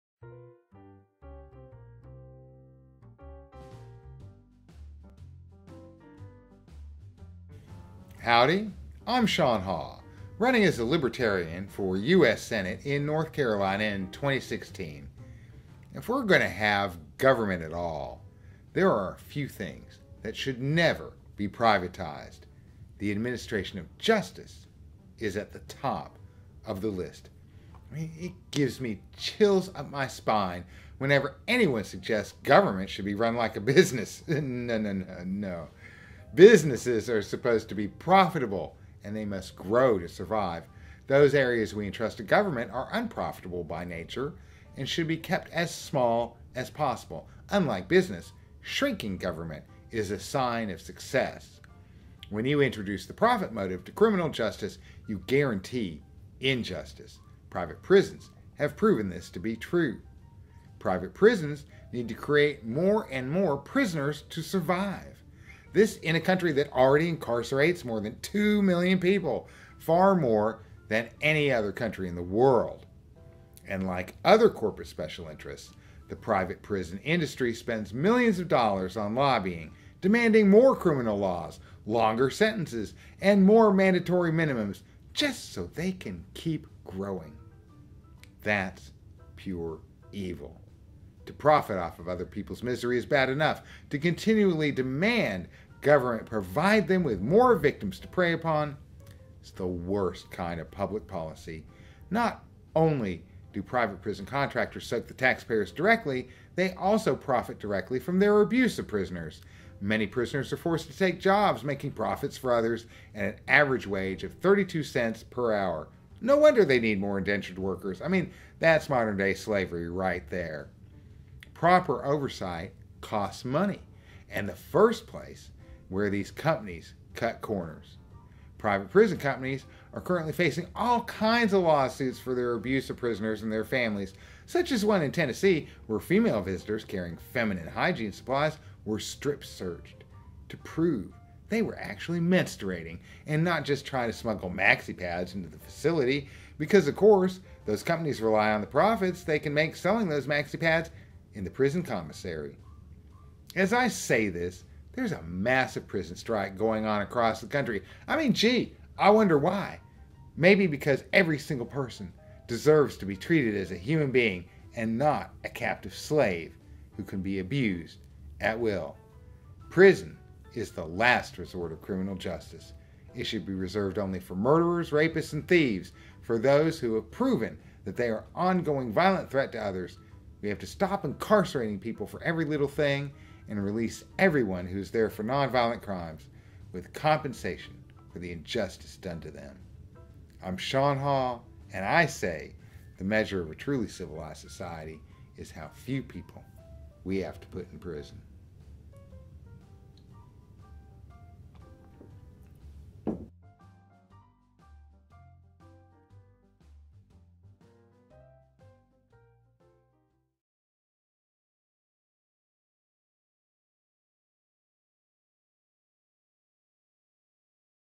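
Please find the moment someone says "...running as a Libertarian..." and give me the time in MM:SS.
00:10.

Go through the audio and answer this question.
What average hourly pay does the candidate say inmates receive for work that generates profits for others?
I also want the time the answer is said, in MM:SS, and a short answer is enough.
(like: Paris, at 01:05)
32 cents, at 01:54.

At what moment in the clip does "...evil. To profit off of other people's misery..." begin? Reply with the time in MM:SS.
01:30.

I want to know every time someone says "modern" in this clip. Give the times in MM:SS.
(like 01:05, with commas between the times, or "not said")
01:58.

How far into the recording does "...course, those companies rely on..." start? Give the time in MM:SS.
02:26.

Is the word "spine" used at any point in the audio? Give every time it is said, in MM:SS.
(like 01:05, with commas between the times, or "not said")
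00:30.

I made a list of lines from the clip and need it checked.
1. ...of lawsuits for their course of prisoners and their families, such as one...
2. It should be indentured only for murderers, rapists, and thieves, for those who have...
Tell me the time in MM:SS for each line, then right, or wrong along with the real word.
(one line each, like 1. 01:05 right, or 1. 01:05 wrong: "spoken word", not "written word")
1. 02:11 wrong: "abuse", not "course"
2. 02:53 wrong: "reserved", not "indentured".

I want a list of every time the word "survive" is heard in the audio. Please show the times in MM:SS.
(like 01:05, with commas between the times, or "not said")
00:40, 01:04.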